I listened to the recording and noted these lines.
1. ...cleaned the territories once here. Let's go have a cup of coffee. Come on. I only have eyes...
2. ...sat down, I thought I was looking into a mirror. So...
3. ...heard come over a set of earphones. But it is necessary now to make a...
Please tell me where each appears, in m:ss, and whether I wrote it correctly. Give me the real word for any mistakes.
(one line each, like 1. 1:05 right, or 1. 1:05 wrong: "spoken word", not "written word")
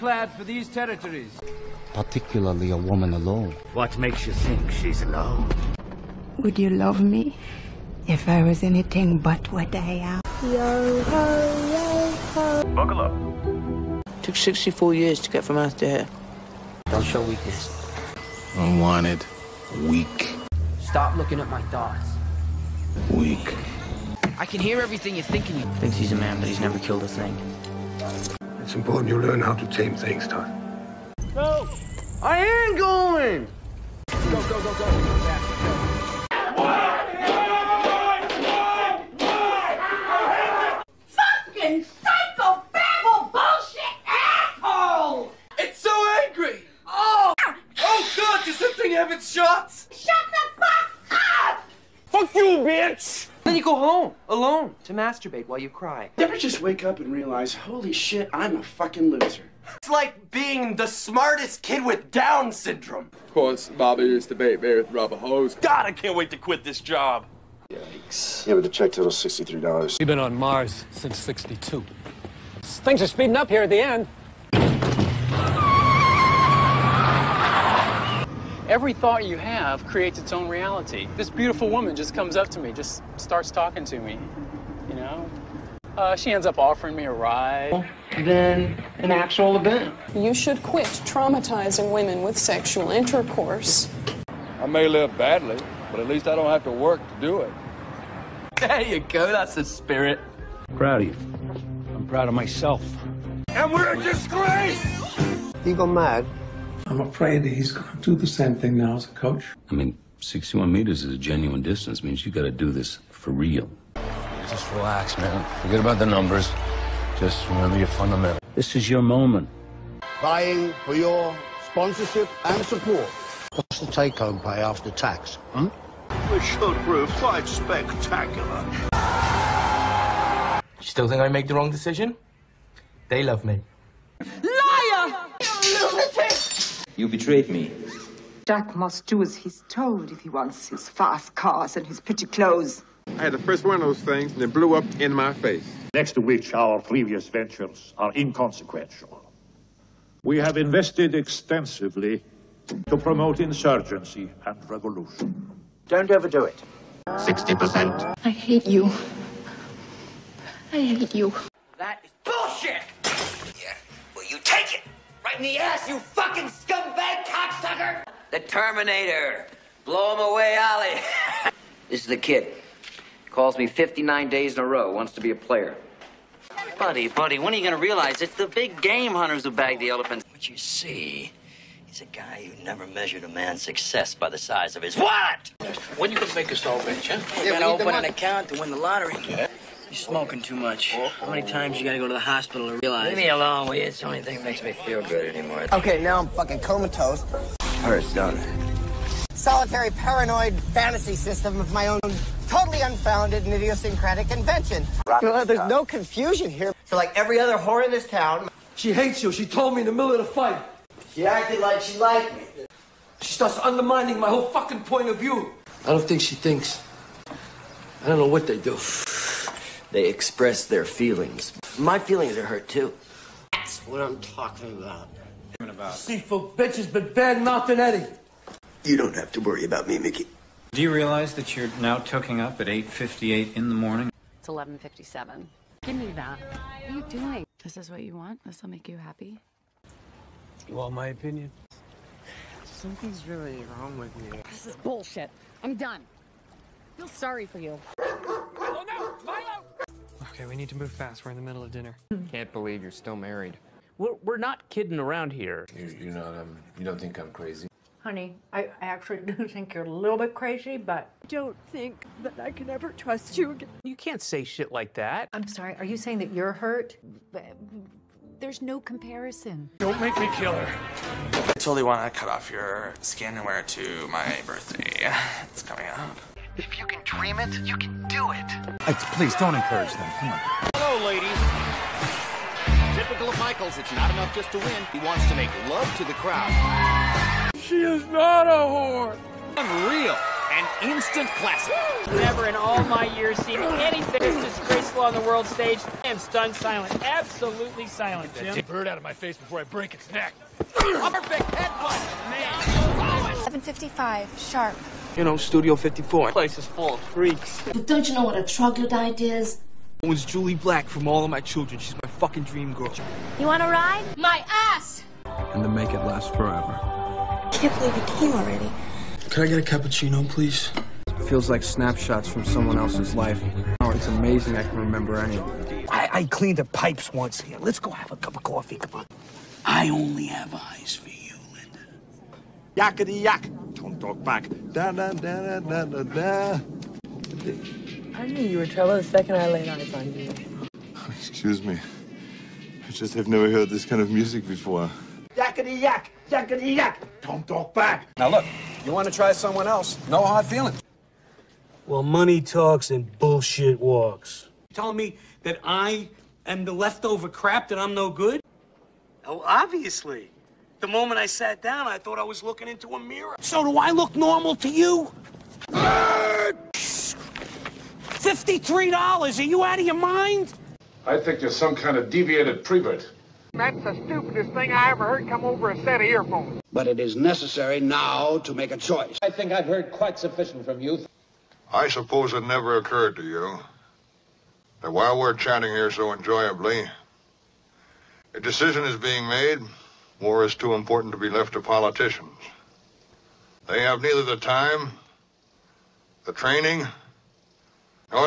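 1. 5:26 wrong: "pipes", not "territories"
2. 6:01 right
3. 6:15 right.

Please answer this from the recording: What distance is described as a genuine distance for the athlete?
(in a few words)
61 meters.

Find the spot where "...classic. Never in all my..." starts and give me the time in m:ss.
4:51.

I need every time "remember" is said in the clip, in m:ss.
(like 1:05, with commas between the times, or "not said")
1:57, 5:24.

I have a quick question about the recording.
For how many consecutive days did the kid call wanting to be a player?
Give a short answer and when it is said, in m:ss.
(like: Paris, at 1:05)
59 days, at 2:53.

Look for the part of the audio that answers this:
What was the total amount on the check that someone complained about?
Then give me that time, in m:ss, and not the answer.
1:09.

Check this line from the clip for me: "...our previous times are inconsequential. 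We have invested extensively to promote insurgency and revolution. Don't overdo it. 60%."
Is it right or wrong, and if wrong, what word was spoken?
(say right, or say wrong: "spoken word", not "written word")
wrong: "ventures", not "times".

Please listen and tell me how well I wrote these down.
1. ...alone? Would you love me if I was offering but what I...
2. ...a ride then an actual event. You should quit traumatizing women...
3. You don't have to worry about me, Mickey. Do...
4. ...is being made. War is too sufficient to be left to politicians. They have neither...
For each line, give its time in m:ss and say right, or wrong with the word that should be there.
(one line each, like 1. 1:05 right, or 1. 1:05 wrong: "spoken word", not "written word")
1. 0:05 wrong: "anything", not "offering"
2. 1:27 right
3. 3:48 right
4. 6:28 wrong: "important", not "sufficient".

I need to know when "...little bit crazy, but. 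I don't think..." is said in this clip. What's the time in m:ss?
4:19.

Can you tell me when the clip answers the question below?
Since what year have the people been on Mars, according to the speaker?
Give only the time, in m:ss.
1:11.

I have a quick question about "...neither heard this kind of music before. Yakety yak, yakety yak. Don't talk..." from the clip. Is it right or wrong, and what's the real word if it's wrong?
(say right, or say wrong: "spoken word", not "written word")
wrong: "never", not "neither".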